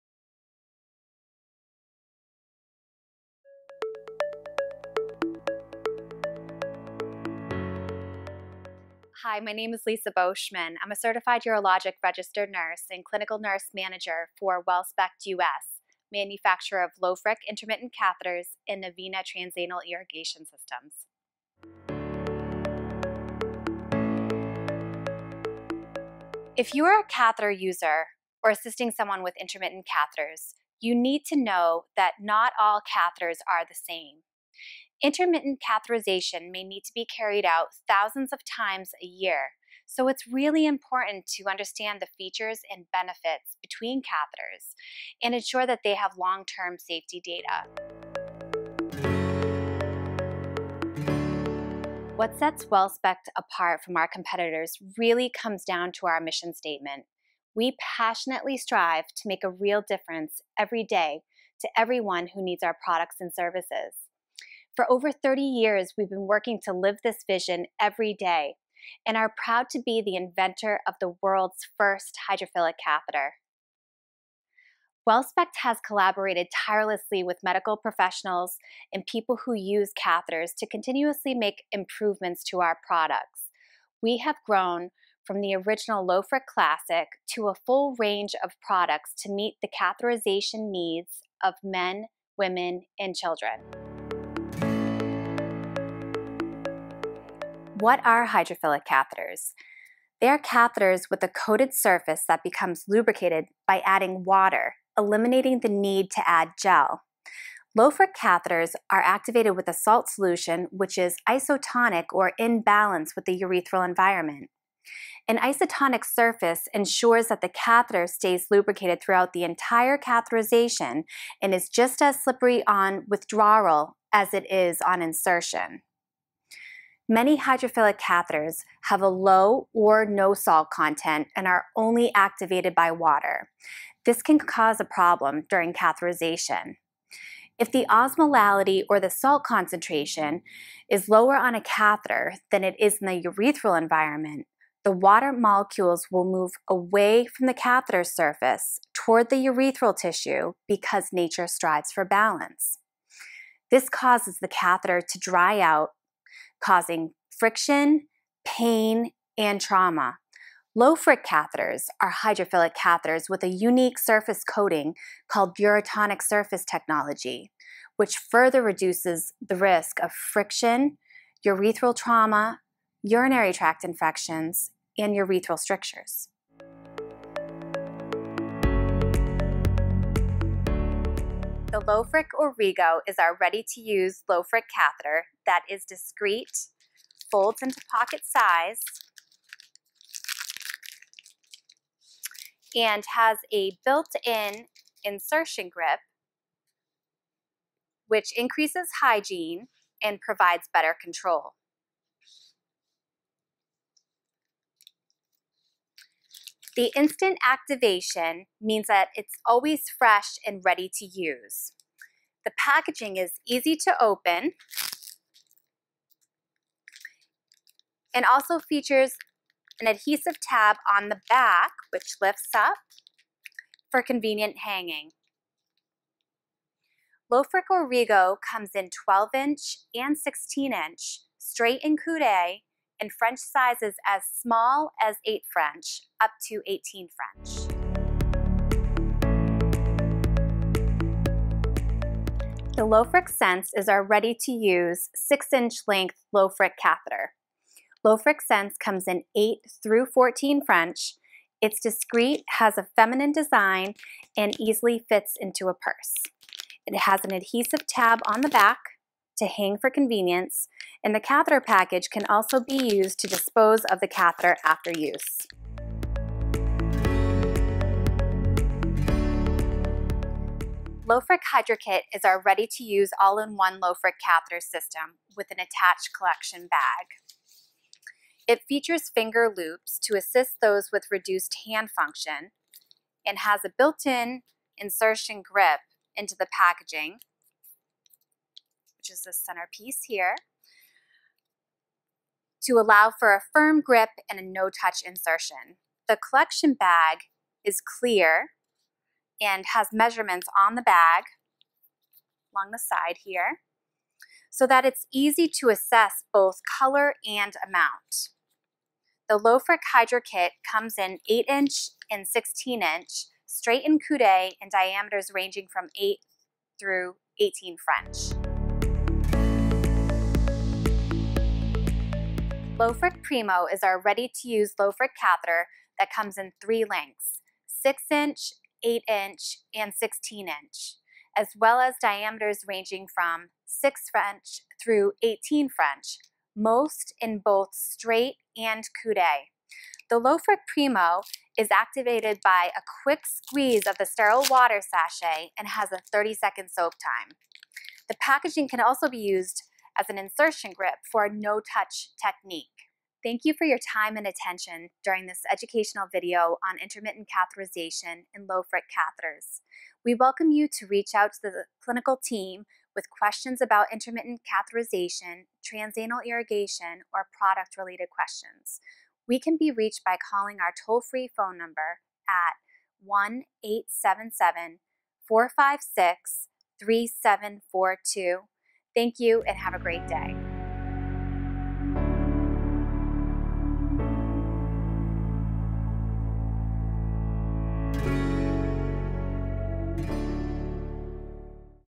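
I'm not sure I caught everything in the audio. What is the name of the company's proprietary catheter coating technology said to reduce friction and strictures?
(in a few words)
Urotonic surface technology.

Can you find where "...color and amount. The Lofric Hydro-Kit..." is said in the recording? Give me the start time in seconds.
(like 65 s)
306 s.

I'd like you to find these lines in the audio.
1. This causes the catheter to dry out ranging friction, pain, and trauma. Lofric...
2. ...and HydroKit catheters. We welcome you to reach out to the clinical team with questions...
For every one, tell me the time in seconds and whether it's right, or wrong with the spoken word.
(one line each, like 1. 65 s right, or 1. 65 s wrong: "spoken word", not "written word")
1. 153 s wrong: "causing", not "ranging"
2. 358 s wrong: "Lofric", not "HydroKit".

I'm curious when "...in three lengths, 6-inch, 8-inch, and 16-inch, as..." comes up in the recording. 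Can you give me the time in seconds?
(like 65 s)
326 s.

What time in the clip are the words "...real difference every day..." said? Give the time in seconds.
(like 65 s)
59 s.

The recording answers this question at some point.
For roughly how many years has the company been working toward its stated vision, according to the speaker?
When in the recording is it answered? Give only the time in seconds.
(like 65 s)
64 s.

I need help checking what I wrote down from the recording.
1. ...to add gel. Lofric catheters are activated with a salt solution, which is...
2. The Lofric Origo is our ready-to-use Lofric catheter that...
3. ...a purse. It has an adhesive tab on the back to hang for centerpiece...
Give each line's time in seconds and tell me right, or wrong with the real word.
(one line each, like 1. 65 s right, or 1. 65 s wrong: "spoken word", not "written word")
1. 106 s right
2. 181 s right
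3. 255 s wrong: "convenience", not "centerpiece".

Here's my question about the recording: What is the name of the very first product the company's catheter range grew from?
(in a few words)
Lofric Classic.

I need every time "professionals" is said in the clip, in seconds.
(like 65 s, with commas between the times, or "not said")
77 s.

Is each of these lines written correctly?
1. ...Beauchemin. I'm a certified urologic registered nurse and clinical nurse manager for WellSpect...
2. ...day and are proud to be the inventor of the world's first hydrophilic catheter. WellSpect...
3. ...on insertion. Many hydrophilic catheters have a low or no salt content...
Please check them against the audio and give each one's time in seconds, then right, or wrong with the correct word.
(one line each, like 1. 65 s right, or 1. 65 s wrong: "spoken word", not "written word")
1. 10 s right
2. 68 s right
3. 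124 s right.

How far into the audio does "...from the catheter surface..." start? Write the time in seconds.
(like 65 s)
147 s.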